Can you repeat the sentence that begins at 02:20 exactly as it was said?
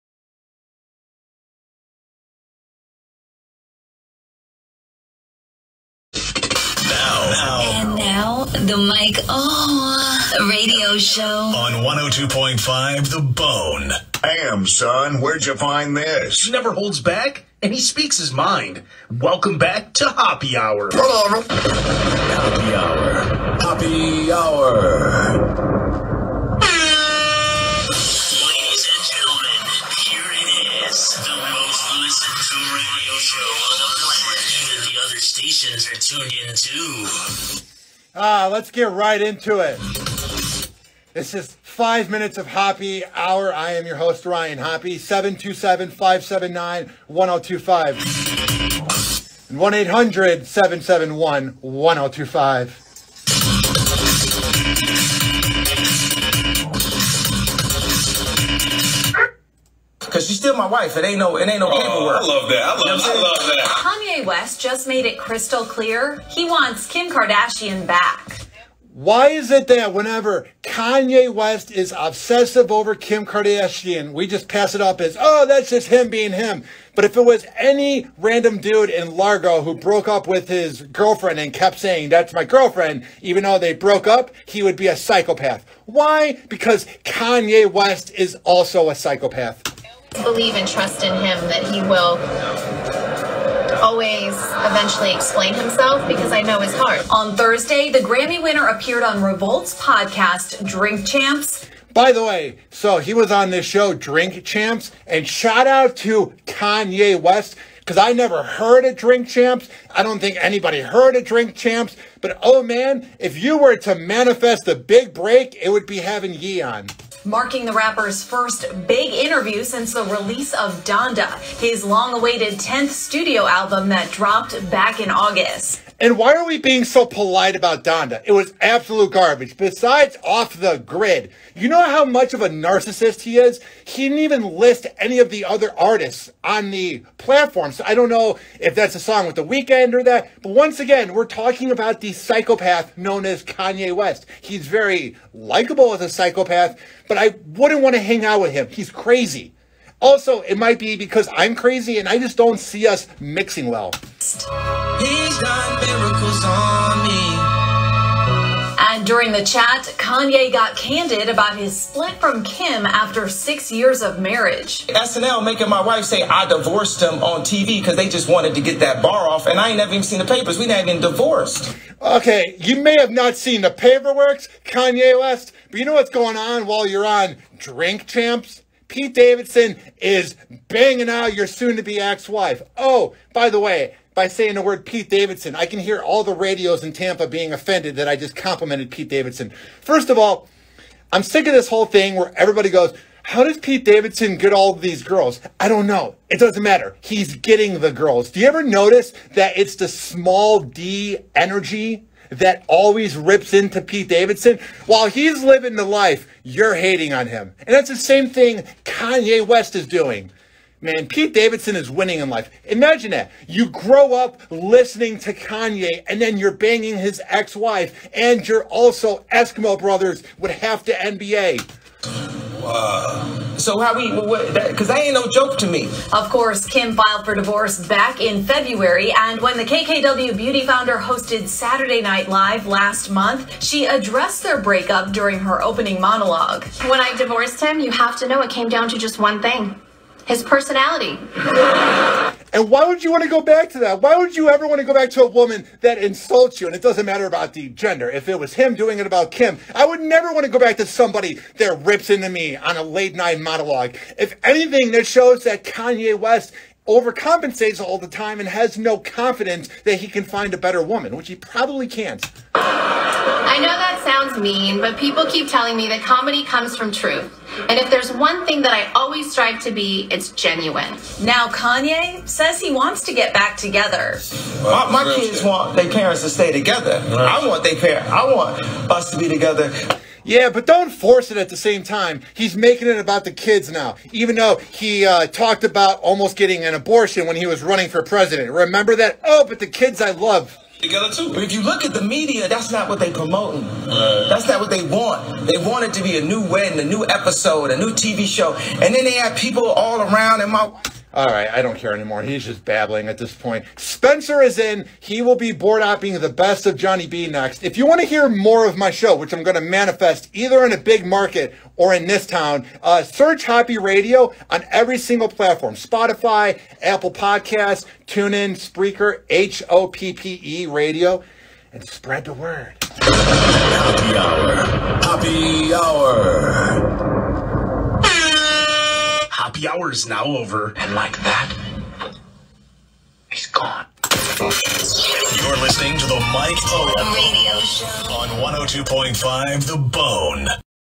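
But once again, we're talking about the psychopath known as Kanye West.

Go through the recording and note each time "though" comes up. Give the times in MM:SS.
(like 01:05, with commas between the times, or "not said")
01:23, 04:44.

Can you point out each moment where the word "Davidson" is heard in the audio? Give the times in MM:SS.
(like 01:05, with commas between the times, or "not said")
02:59, 03:05, 03:09, 03:13, 03:24, 03:31.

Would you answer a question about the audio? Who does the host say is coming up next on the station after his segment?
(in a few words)
Johnny B.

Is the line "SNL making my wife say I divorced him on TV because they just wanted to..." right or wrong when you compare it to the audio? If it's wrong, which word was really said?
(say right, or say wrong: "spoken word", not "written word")
right.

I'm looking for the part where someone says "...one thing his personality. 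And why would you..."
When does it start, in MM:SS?
03:59.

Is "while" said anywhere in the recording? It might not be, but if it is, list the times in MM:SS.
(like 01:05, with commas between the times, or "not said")
02:56, 03:24.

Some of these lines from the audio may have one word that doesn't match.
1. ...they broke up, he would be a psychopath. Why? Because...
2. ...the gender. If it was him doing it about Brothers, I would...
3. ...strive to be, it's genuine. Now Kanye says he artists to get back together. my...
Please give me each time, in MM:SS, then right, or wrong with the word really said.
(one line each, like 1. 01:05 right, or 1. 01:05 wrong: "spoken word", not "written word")
1. 01:23 right
2. 04:07 wrong: "Kim", not "Brothers"
3. 04:29 wrong: "wants", not "artists".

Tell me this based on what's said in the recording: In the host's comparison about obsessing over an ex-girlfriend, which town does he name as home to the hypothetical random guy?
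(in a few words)
Largo.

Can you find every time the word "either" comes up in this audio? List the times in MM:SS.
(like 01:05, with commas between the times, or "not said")
05:10.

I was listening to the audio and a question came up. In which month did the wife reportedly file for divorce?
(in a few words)
February.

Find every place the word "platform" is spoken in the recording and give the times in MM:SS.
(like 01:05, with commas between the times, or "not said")
02:17, 05:15.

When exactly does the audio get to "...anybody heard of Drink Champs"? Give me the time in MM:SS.
01:50.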